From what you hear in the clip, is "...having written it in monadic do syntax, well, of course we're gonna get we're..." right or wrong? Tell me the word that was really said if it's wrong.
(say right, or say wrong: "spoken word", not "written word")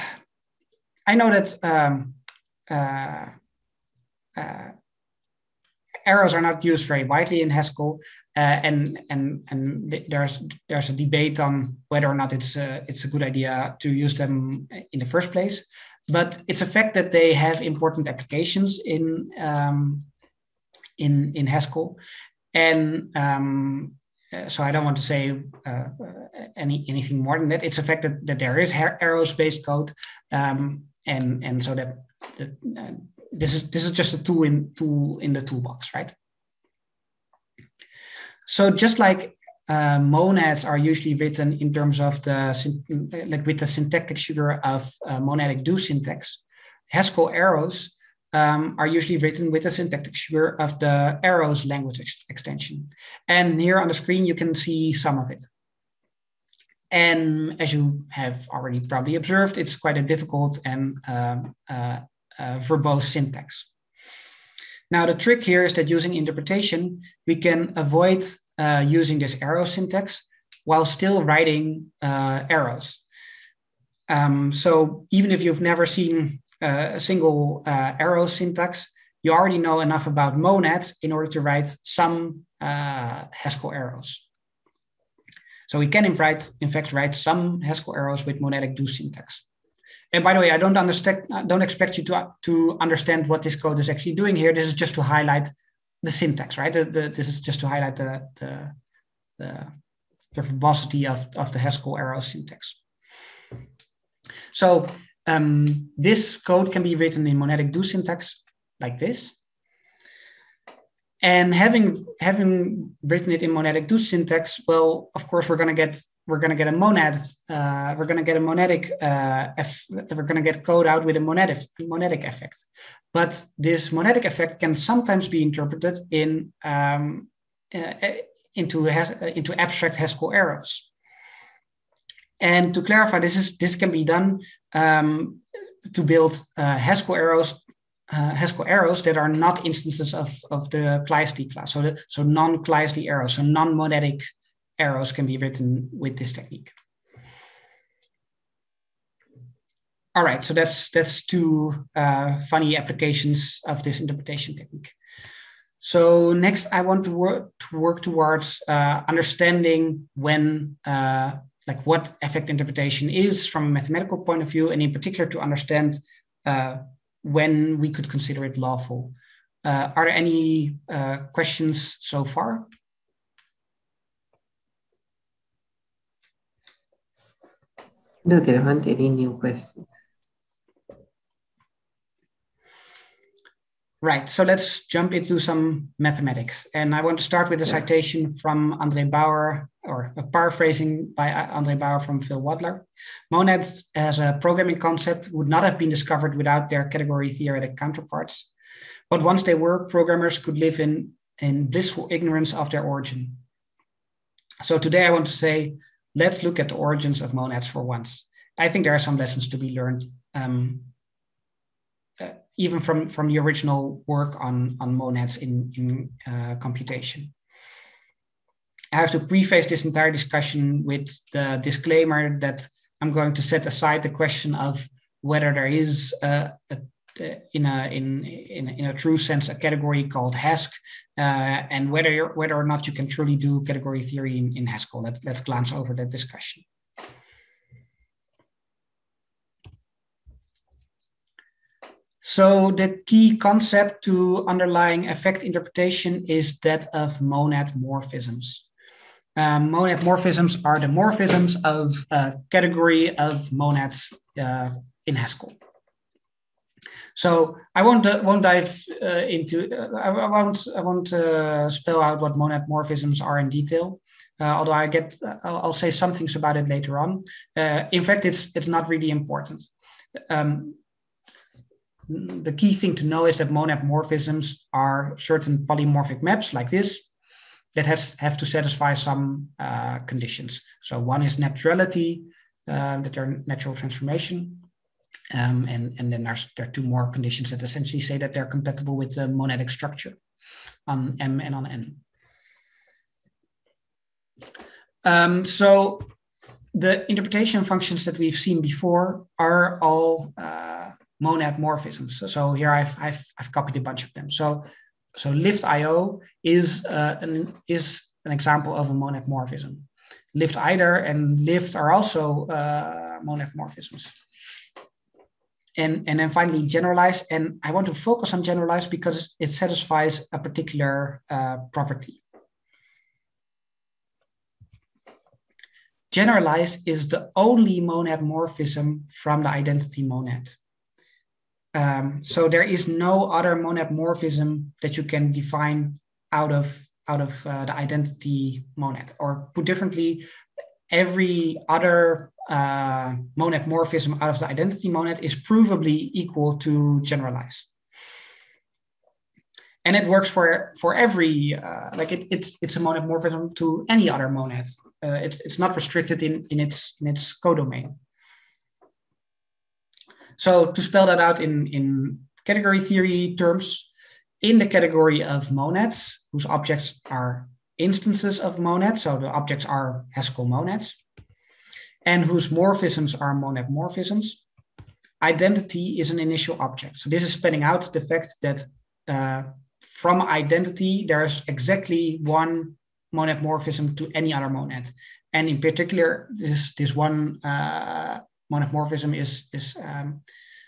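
right.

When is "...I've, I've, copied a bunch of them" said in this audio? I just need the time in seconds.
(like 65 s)
303 s.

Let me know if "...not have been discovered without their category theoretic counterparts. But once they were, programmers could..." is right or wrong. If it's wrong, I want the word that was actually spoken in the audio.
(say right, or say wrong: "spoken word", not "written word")
right.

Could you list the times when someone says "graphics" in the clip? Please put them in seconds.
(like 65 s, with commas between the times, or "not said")
not said.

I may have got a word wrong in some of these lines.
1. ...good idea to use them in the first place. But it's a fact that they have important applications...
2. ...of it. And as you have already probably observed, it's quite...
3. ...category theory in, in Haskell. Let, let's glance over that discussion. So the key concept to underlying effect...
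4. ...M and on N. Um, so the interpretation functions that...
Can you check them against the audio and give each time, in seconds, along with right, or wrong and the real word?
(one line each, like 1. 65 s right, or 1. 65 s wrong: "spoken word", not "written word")
1. 13 s right
2. 55 s right
3. 233 s right
4. 291 s right.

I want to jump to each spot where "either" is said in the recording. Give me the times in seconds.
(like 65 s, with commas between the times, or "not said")
310 s.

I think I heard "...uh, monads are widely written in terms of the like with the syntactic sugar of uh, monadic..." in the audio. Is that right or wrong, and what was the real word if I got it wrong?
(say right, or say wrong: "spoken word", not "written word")
wrong: "usually", not "widely".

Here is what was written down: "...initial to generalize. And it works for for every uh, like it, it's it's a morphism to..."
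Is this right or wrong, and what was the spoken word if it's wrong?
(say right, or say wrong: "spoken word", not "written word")
wrong: "equal", not "initial".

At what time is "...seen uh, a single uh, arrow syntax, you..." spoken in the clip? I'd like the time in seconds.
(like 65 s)
75 s.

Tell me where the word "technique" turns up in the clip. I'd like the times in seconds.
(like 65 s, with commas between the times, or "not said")
146 s, 154 s.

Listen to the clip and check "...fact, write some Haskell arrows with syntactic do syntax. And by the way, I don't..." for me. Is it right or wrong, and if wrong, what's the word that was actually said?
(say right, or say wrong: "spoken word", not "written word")
wrong: "monadic", not "syntactic".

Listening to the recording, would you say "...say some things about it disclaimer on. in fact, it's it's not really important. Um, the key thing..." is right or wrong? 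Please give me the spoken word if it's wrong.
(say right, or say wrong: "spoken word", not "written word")
wrong: "later", not "disclaimer".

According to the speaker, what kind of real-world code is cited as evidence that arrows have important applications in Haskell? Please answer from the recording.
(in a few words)
aerospace code.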